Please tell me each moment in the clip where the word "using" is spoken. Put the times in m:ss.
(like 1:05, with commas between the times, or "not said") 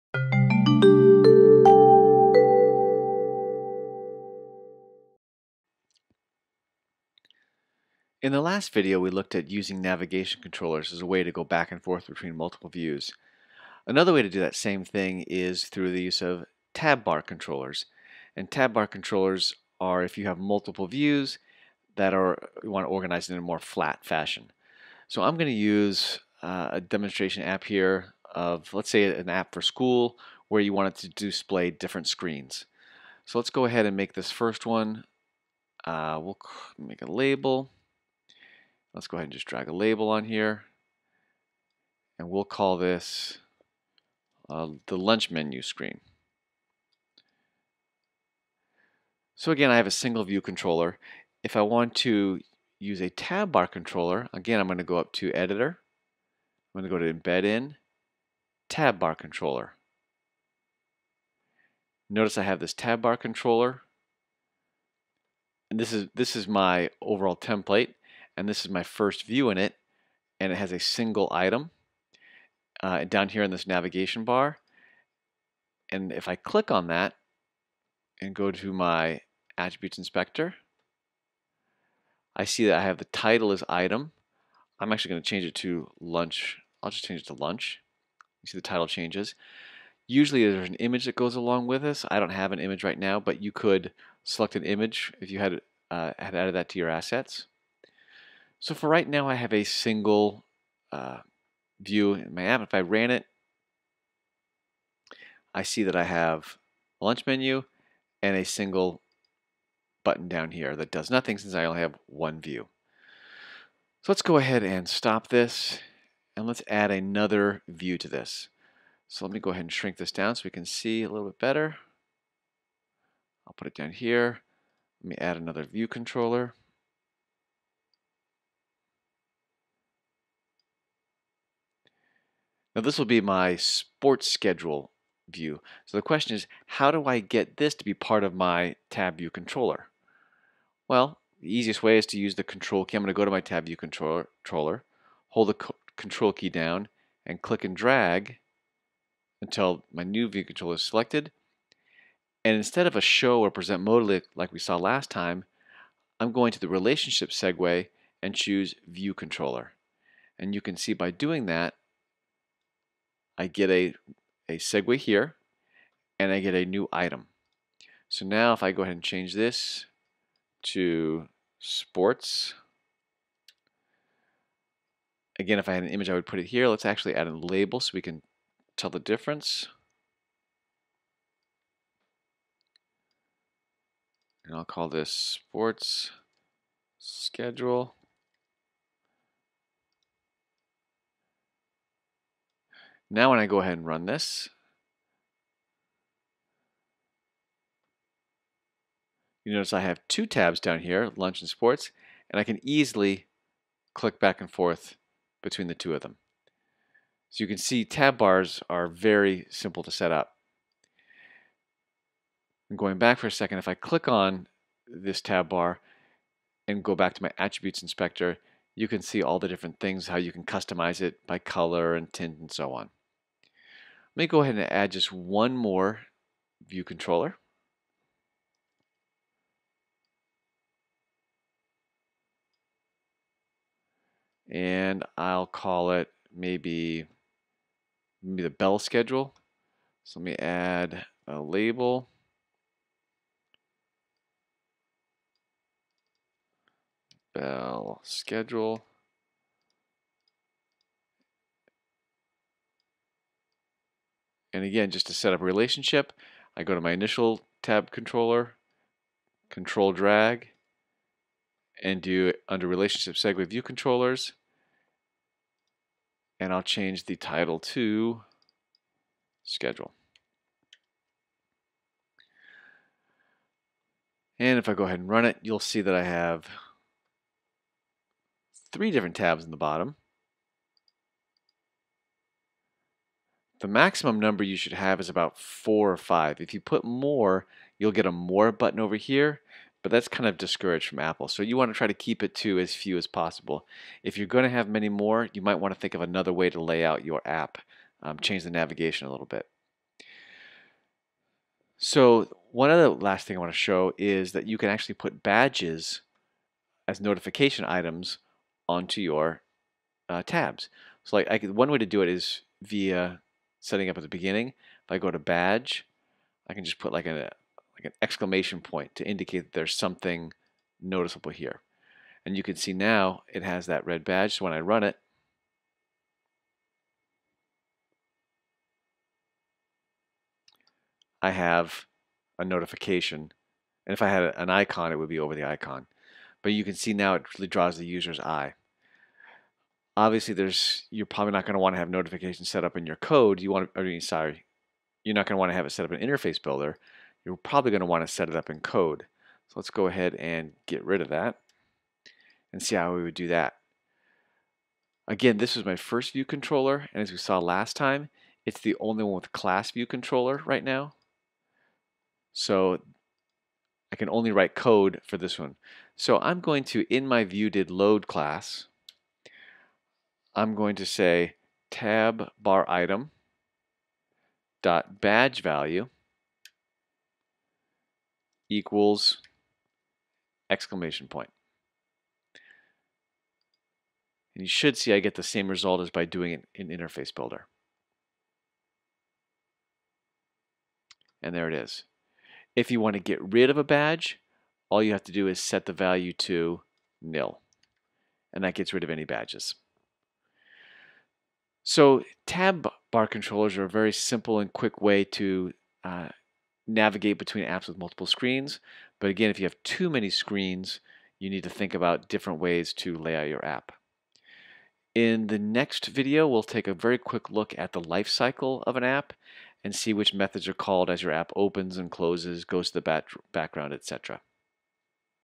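0:09.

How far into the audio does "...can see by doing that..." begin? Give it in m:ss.
2:40.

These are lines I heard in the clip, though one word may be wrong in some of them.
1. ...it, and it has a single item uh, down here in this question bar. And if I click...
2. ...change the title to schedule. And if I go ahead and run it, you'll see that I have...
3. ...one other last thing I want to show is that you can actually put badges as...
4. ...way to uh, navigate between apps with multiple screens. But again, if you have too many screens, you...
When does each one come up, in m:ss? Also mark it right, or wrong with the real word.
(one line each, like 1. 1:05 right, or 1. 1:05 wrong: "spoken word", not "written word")
1. 1:09 wrong: "navigation", not "question"
2. 4:26 right
3. 5:02 right
4. 6:44 right.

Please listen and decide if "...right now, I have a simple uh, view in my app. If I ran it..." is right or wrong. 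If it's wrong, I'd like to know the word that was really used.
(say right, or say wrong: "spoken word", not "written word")
wrong: "single", not "simple".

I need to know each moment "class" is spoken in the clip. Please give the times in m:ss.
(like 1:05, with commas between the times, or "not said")
5:59, 6:08.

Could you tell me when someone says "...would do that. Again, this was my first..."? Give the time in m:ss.
5:53.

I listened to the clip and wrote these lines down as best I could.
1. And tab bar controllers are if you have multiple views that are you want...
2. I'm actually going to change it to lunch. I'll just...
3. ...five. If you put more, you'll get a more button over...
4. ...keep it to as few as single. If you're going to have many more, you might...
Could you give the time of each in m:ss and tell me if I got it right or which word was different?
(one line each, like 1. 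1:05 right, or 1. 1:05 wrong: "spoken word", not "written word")
1. 0:18 right
2. 1:24 right
3. 4:45 right
4. 4:51 wrong: "possible", not "single".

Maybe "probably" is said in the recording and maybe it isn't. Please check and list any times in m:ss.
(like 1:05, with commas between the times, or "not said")
5:41, 5:47.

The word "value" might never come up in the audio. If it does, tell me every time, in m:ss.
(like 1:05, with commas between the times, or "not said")
6:15, 6:35.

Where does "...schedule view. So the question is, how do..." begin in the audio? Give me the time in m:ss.
2:14.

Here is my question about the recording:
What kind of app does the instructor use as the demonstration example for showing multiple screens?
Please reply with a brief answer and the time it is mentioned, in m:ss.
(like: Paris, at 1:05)
An app for school, at 0:29.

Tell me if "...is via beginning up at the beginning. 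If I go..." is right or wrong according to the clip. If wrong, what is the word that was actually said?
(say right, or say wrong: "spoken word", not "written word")
wrong: "setting", not "beginning".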